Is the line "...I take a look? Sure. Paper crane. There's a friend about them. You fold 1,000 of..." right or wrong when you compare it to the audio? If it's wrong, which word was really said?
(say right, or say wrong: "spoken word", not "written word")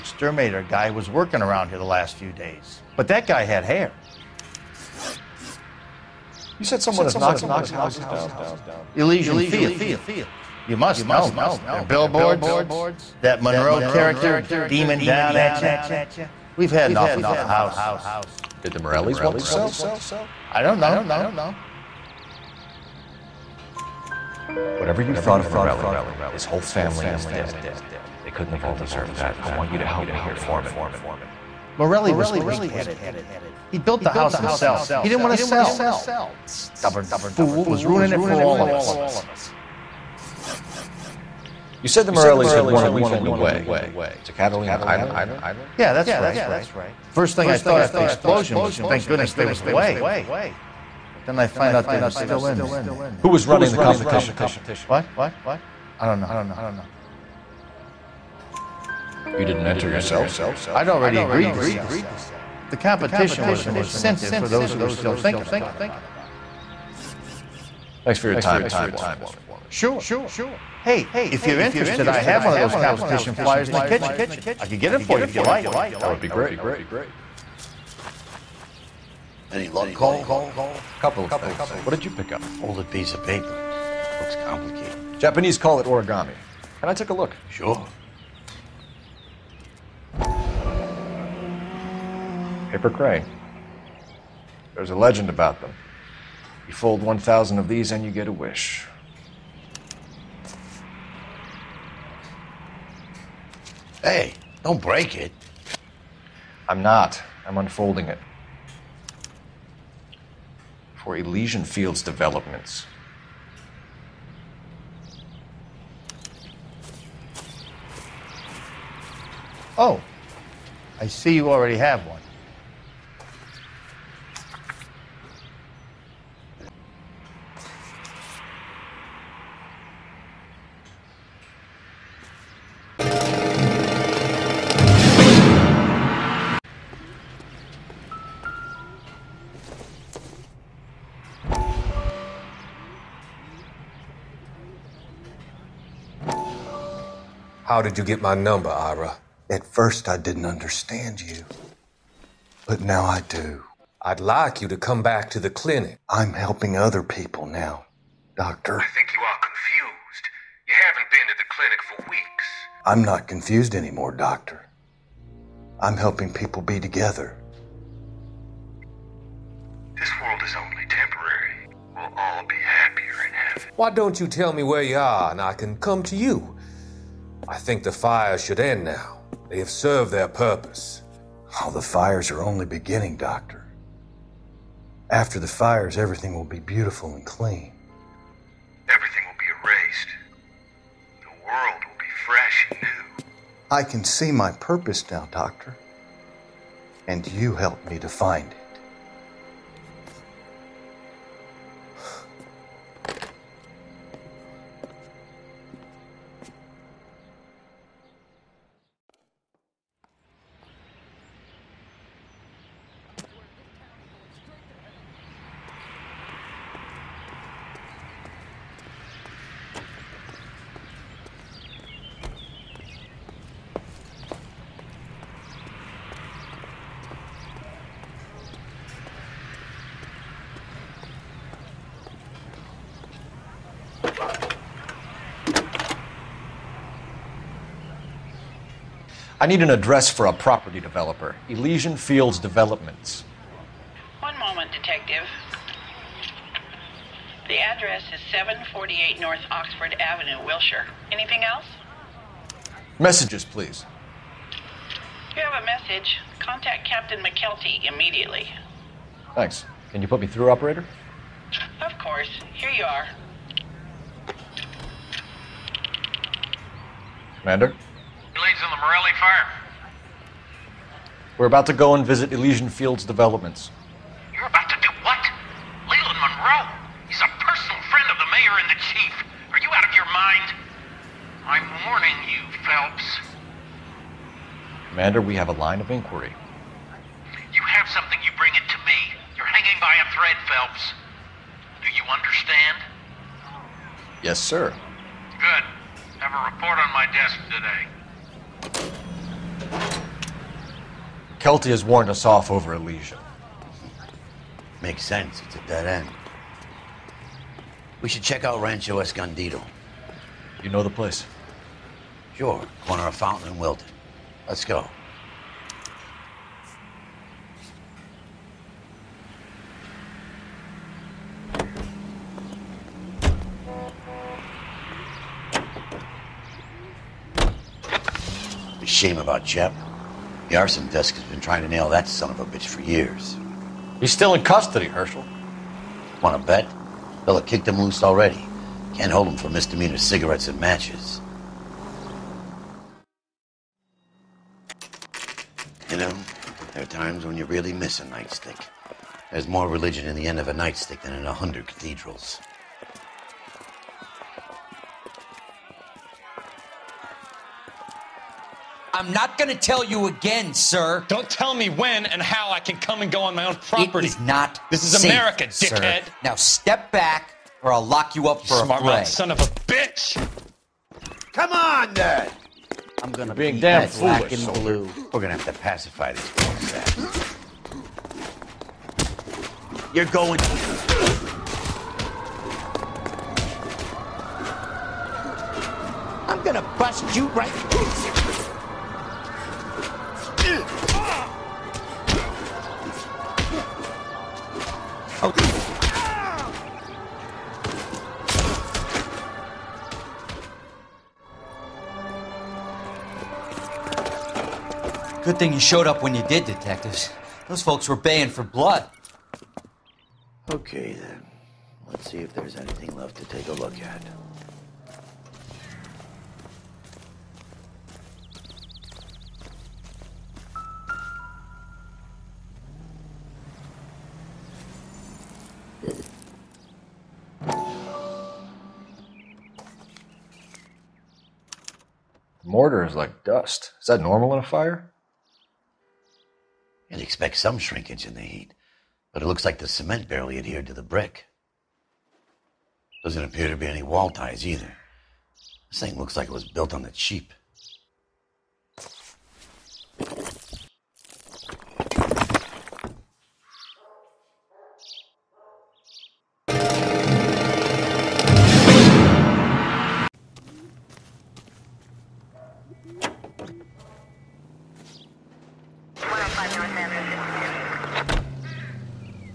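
wrong: "legend", not "friend".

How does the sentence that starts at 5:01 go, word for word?
Kelty has warned us off over Elysium.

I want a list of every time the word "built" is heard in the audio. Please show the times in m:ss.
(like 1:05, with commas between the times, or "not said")
0:33, 7:26.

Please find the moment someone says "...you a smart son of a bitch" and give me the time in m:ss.
6:08.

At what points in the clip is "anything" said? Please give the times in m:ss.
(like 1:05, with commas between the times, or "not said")
4:11, 6:52.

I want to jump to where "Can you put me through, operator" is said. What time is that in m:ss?
4:19.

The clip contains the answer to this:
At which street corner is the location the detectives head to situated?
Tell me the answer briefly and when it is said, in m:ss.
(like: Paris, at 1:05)
Fountain and Wilton, at 5:13.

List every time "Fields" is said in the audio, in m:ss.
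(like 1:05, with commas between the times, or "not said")
0:09, 1:51, 4:01, 4:32.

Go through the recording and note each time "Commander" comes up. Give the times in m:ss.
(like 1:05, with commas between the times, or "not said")
4:27, 4:44.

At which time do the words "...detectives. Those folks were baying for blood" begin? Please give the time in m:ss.
6:46.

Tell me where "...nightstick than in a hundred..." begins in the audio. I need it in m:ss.
5:50.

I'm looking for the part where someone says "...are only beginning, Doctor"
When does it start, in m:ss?
3:02.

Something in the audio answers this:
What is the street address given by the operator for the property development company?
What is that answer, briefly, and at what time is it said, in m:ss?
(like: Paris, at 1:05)
748 North Oxford Avenue, at 4:08.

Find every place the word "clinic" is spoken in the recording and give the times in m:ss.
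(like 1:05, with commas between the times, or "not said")
2:35, 2:41.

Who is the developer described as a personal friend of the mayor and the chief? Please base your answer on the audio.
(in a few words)
Leland Monroe.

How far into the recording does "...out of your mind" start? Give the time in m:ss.
4:39.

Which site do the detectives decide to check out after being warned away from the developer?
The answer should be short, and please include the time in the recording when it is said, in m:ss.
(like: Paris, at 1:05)
Rancho Escondido, at 5:08.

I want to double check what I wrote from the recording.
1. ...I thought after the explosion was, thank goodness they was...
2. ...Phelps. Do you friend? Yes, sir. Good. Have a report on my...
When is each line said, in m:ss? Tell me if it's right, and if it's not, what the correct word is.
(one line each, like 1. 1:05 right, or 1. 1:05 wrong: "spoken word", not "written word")
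1. 0:47 right
2. 4:50 wrong: "understand", not "friend".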